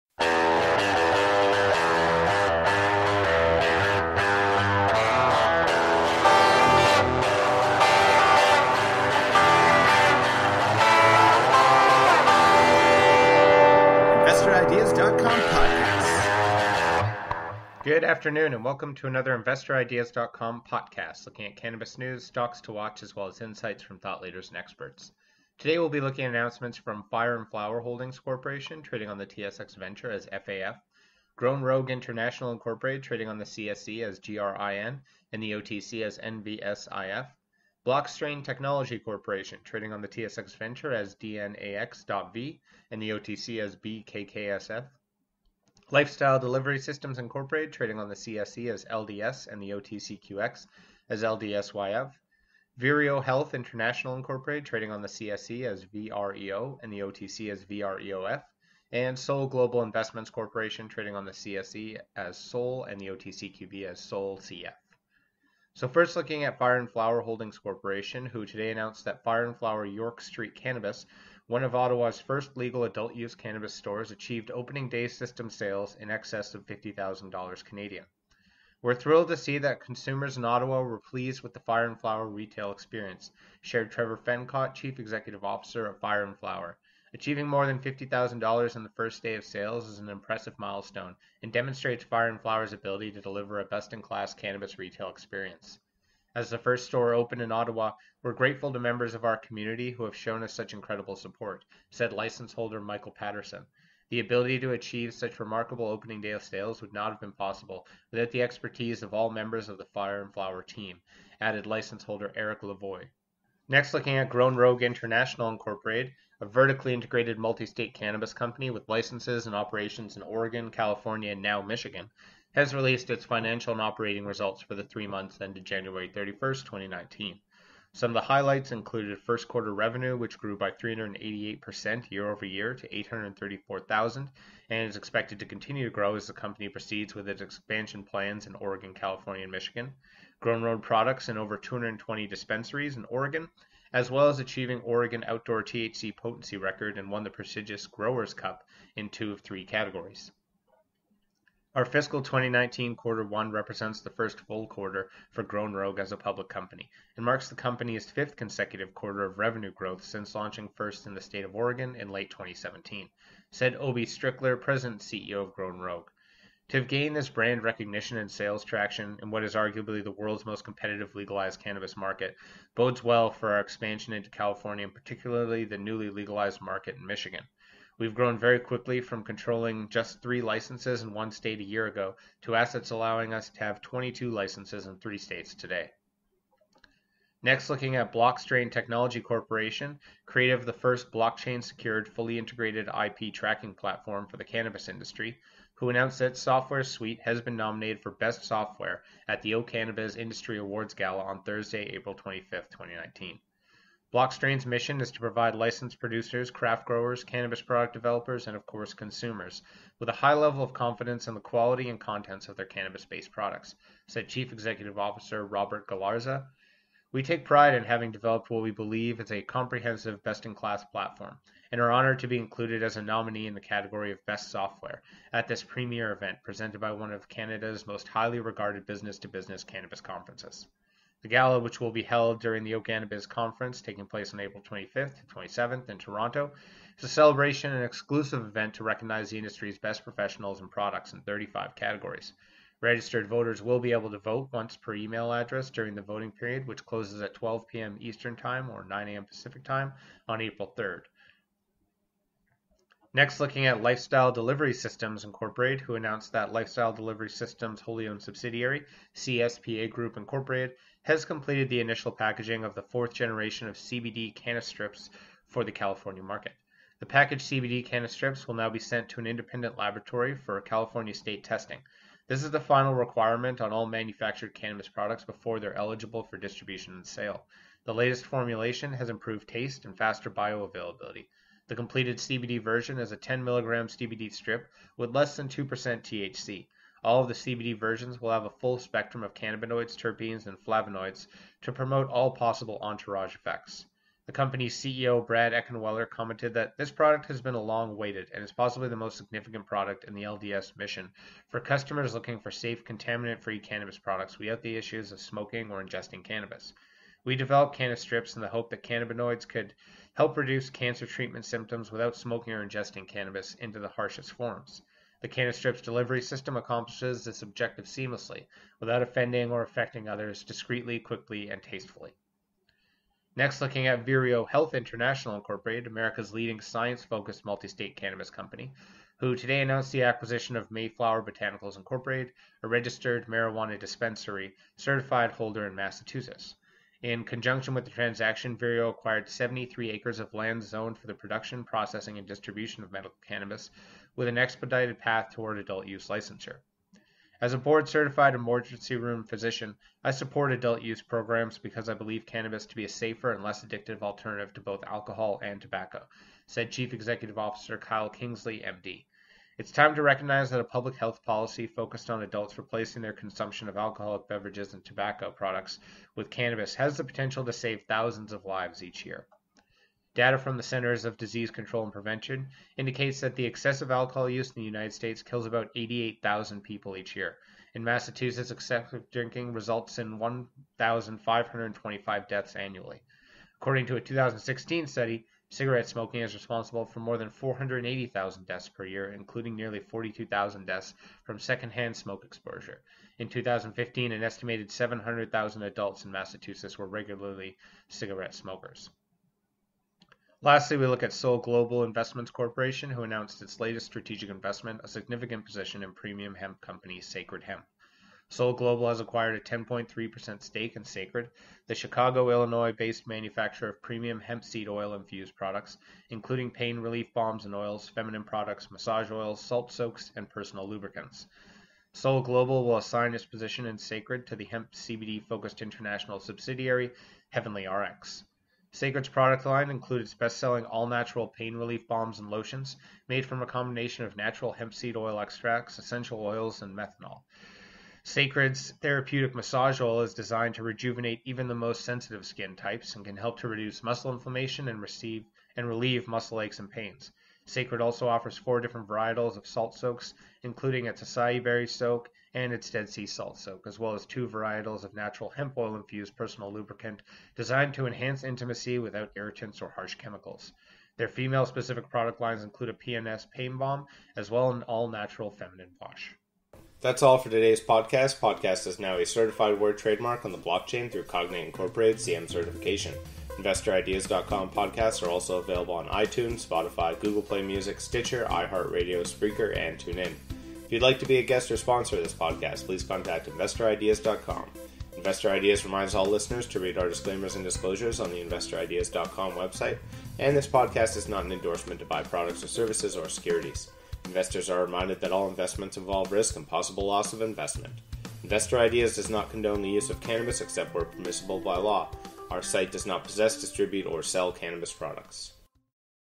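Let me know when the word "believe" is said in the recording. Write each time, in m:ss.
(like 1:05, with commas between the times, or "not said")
3:38, 5:51.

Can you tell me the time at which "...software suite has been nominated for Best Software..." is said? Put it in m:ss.
3:16.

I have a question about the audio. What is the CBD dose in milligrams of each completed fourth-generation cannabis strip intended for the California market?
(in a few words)
10 milligrams.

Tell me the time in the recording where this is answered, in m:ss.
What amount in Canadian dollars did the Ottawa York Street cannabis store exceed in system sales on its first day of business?
1:16.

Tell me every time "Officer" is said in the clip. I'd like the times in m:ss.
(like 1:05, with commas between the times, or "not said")
1:25, 3:34, 5:57.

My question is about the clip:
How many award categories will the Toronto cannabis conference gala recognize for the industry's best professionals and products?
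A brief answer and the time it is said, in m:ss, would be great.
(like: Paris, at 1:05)
35, at 4:01.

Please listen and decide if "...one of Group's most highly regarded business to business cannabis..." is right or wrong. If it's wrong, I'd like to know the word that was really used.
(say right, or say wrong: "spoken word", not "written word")
wrong: "Canada", not "Group".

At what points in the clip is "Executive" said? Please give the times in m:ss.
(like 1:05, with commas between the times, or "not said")
1:24, 3:34, 5:56.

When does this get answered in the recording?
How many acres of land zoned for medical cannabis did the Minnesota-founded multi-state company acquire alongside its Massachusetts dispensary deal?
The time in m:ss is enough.
5:39.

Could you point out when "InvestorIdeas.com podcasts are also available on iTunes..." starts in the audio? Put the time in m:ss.
7:53.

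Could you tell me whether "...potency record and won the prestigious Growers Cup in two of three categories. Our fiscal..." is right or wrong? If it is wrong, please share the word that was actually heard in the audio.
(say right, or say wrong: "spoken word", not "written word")
right.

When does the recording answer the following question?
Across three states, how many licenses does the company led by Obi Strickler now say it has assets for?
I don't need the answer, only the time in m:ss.
3:03.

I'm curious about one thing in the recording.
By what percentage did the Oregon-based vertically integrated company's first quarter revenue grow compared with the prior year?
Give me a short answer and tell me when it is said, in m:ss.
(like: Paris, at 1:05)
388%, at 2:10.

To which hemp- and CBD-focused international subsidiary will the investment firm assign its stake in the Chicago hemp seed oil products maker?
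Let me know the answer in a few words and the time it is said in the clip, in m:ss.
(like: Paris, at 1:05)
Heavenly RX, at 7:07.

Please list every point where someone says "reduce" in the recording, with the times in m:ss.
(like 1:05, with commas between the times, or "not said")
5:10, 7:23.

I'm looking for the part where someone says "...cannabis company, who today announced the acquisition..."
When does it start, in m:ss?
5:27.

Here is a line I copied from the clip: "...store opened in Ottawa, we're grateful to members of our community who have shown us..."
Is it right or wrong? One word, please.
right.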